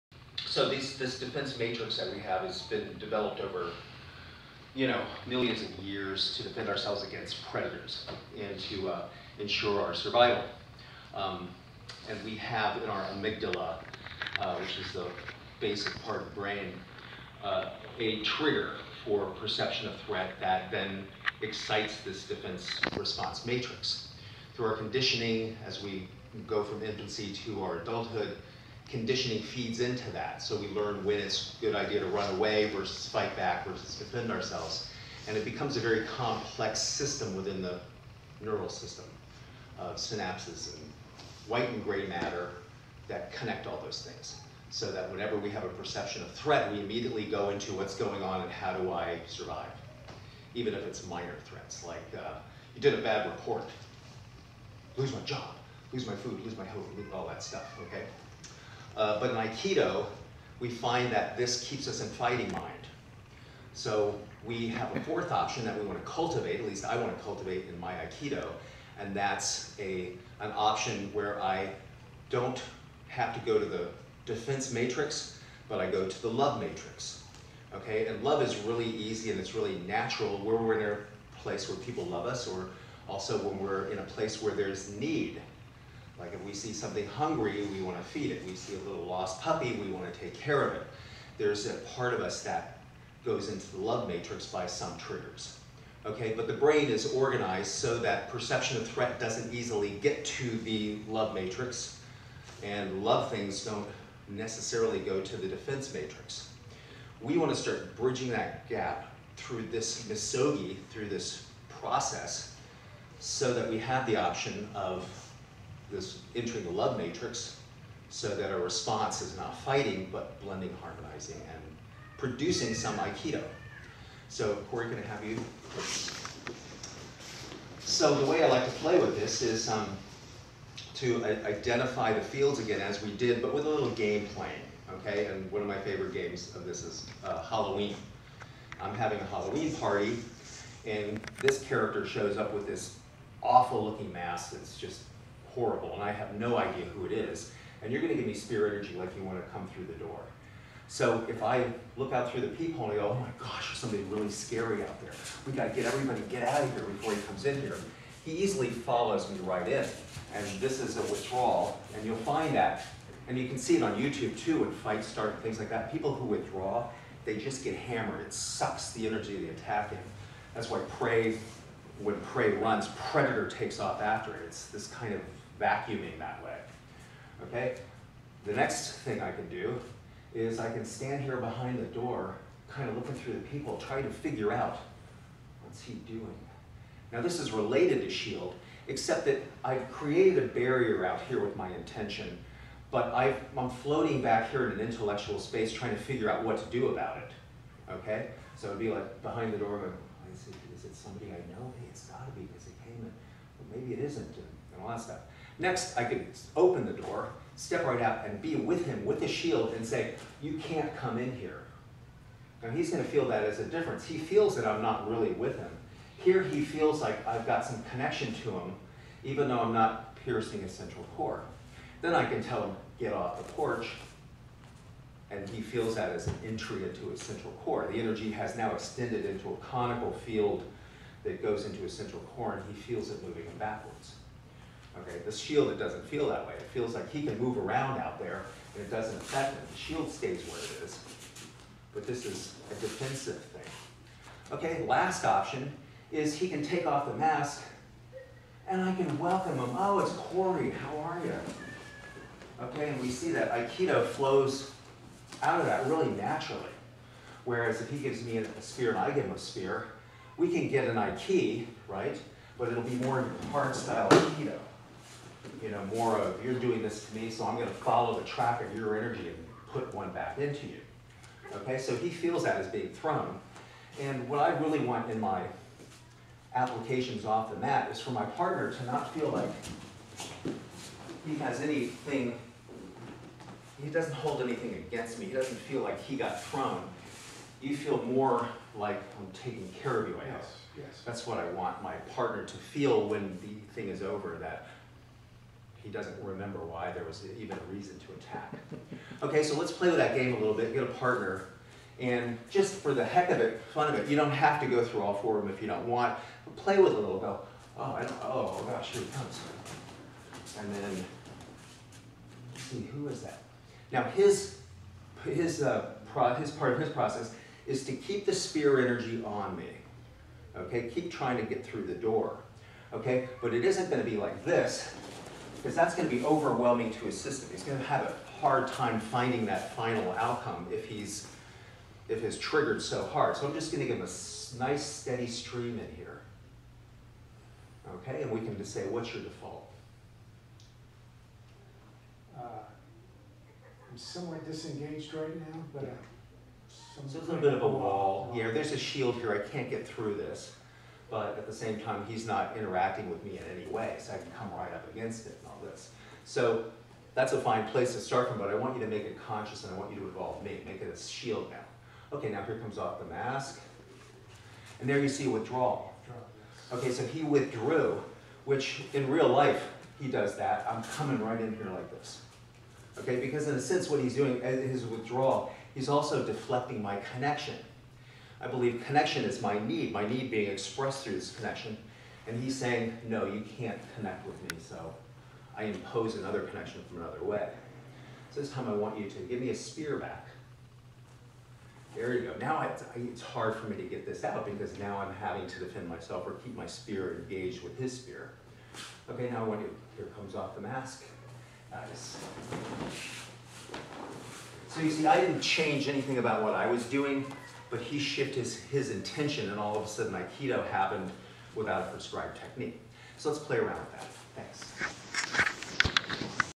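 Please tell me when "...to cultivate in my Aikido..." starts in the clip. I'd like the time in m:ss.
1:07.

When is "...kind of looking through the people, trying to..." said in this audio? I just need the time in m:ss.
3:02.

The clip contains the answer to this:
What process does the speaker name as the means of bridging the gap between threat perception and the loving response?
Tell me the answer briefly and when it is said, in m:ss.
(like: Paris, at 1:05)
misogi, at 1:50.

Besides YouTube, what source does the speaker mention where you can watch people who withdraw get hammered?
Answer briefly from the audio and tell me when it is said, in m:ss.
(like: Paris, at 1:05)
Fight Start, at 2:44.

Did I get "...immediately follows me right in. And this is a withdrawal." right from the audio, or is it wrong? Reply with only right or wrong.
wrong.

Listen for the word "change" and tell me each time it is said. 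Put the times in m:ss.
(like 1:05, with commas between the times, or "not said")
6:45.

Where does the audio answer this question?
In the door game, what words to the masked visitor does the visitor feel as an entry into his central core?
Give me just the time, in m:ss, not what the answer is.
3:42.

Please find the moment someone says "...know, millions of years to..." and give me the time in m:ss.
0:04.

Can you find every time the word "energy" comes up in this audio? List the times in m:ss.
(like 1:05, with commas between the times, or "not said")
2:28, 2:49, 3:47, 4:28, 5:18.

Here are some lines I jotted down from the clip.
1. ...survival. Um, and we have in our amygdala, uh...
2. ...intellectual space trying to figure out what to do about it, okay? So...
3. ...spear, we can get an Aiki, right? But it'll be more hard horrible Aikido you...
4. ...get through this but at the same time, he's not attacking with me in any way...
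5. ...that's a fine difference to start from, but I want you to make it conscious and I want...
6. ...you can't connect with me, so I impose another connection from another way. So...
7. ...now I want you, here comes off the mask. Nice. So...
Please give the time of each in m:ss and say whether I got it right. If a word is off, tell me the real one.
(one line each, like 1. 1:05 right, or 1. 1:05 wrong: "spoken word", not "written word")
1. 0:09 right
2. 3:14 right
3. 4:19 wrong: "style", not "horrible"
4. 5:49 wrong: "interacting", not "attacking"
5. 5:57 wrong: "place", not "difference"
6. 6:23 right
7. 6:39 right.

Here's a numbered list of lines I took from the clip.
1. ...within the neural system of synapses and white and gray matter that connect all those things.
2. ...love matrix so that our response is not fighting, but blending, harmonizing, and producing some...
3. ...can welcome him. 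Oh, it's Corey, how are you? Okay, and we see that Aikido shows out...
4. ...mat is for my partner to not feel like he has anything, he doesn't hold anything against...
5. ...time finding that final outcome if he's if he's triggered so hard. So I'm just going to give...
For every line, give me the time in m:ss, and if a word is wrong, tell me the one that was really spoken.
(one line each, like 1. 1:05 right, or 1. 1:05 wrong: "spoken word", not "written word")
1. 0:37 right
2. 1:56 right
3. 4:08 wrong: "flows", not "shows"
4. 4:37 right
5. 5:28 right.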